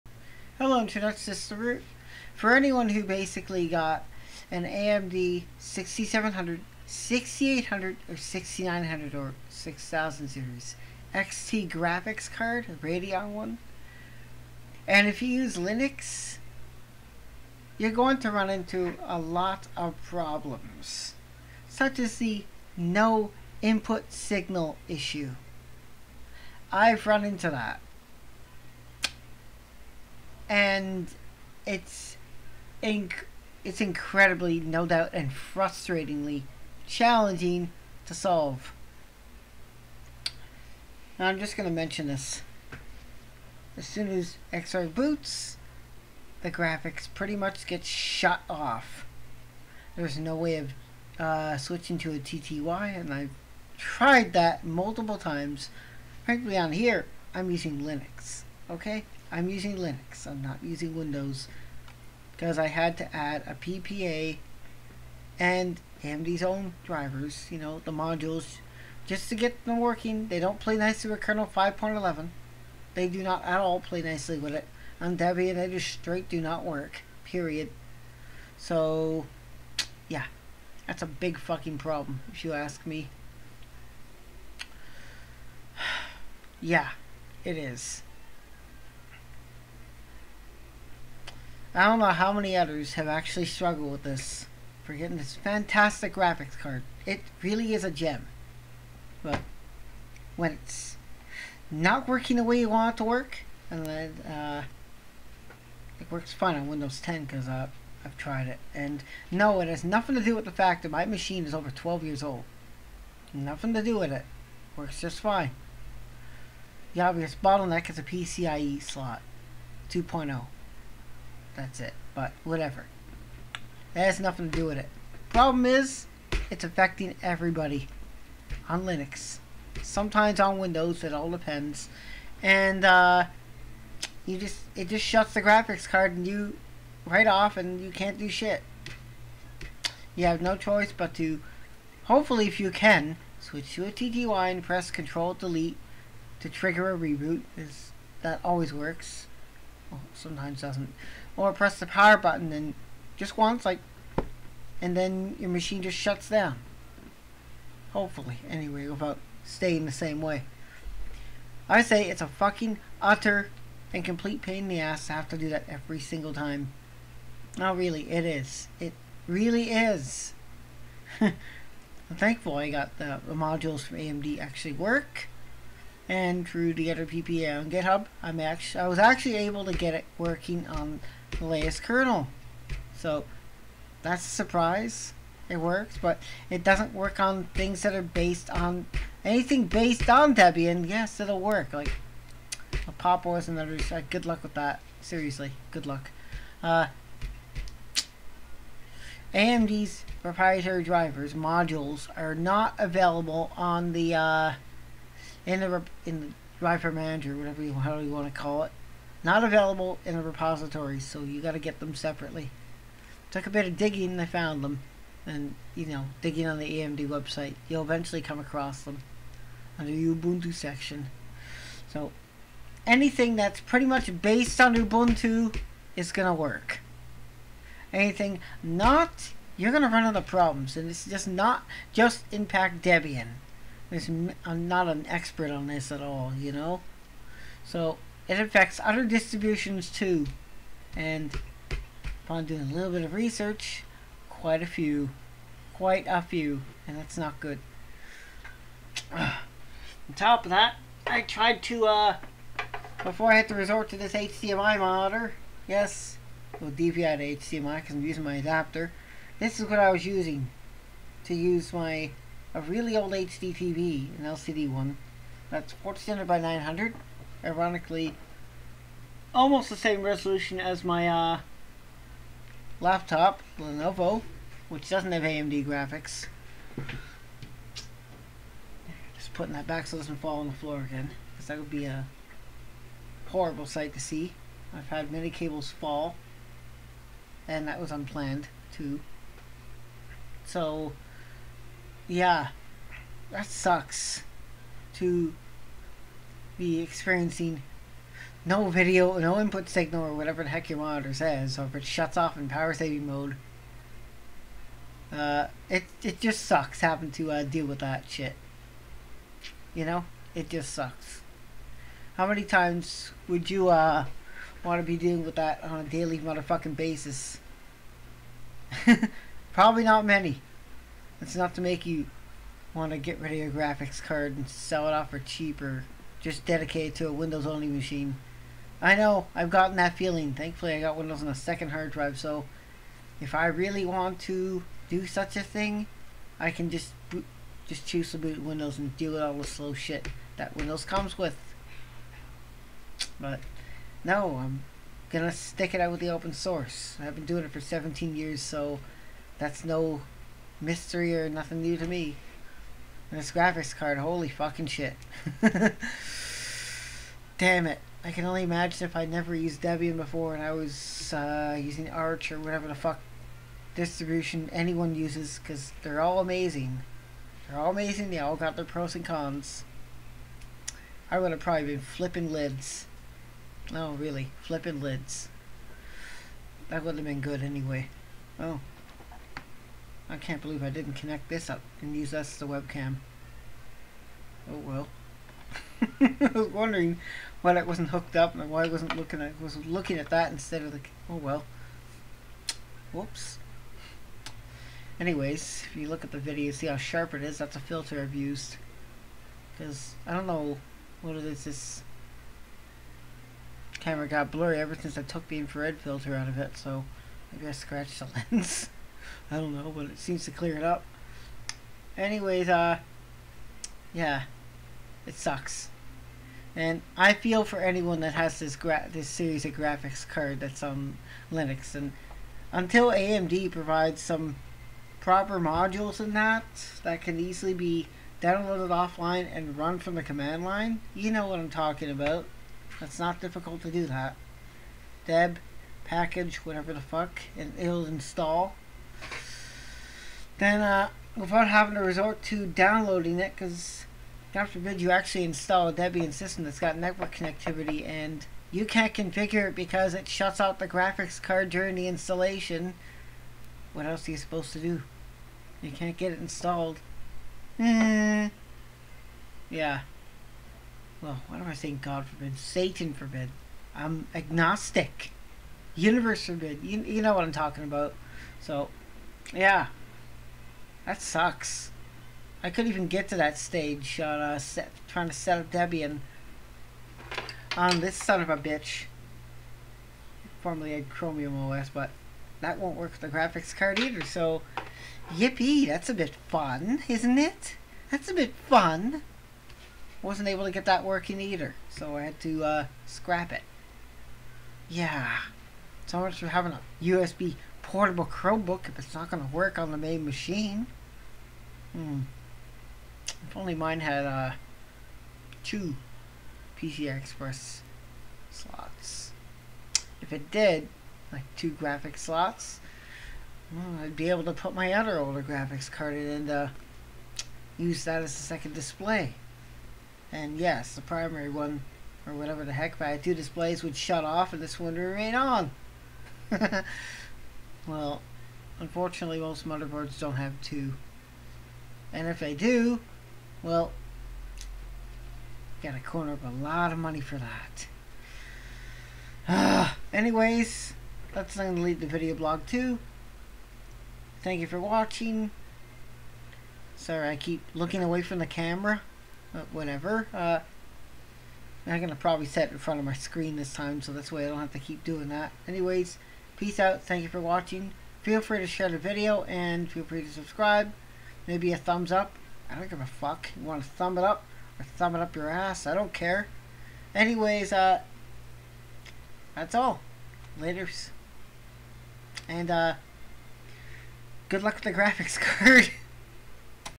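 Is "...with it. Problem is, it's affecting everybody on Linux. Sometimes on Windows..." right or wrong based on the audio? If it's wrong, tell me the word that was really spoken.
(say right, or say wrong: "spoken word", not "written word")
right.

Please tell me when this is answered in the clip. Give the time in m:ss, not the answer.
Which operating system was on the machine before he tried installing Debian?
8:00.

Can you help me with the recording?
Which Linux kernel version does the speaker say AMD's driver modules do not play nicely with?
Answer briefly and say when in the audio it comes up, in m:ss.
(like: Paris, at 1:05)
5.11, at 1:11.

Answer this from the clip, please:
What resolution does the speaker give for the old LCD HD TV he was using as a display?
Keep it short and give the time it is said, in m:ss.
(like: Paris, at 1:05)
1400 by 900, at 4:25.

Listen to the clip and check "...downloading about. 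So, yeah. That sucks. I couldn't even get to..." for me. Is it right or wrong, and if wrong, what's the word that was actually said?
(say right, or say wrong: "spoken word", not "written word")
wrong: "talking", not "downloading".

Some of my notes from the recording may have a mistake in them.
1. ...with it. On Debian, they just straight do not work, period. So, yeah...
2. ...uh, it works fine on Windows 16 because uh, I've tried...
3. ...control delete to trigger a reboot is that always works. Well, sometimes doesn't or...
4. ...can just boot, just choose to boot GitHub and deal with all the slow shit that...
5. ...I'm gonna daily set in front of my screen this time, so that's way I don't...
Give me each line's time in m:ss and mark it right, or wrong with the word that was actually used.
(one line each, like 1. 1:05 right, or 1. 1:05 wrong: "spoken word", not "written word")
1. 1:14 right
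2. 1:44 wrong: "10", not "16"
3. 2:24 right
4. 5:36 wrong: "Windows", not "GitHub"
5. 9:11 wrong: "probably", not "daily".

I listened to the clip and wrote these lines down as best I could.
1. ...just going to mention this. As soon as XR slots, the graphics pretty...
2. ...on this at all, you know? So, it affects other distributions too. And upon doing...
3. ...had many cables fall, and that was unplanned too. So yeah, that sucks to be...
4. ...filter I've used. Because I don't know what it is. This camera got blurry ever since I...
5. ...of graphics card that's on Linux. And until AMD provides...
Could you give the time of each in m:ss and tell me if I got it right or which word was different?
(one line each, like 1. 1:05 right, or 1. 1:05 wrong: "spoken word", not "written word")
1. 0:41 wrong: "boots", not "slots"
2. 3:55 right
3. 4:44 right
4. 6:37 right
5. 6:59 right.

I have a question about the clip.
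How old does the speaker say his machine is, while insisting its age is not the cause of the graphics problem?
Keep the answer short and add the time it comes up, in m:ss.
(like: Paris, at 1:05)
over 12 years, at 1:51.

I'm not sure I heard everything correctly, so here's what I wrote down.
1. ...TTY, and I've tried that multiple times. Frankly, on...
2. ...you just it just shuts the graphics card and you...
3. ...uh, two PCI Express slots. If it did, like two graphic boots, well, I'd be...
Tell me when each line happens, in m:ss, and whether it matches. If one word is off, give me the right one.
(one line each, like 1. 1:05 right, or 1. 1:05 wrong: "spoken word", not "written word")
1. 0:52 right
2. 2:14 right
3. 8:24 wrong: "slots", not "boots".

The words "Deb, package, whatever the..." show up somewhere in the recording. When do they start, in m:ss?
7:15.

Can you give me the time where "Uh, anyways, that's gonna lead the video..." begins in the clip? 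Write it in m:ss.
8:59.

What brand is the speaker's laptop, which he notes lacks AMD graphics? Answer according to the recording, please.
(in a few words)
Lenovo.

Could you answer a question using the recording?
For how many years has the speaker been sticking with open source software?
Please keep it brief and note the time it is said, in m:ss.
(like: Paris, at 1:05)
17, at 5:47.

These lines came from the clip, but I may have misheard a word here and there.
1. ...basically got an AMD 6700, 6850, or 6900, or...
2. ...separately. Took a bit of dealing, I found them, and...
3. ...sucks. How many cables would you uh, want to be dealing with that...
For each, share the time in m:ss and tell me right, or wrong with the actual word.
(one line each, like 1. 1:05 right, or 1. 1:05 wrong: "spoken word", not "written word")
1. 0:03 wrong: "6800", not "6850"
2. 3:31 wrong: "digging", not "dealing"
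3. 5:10 wrong: "times", not "cables".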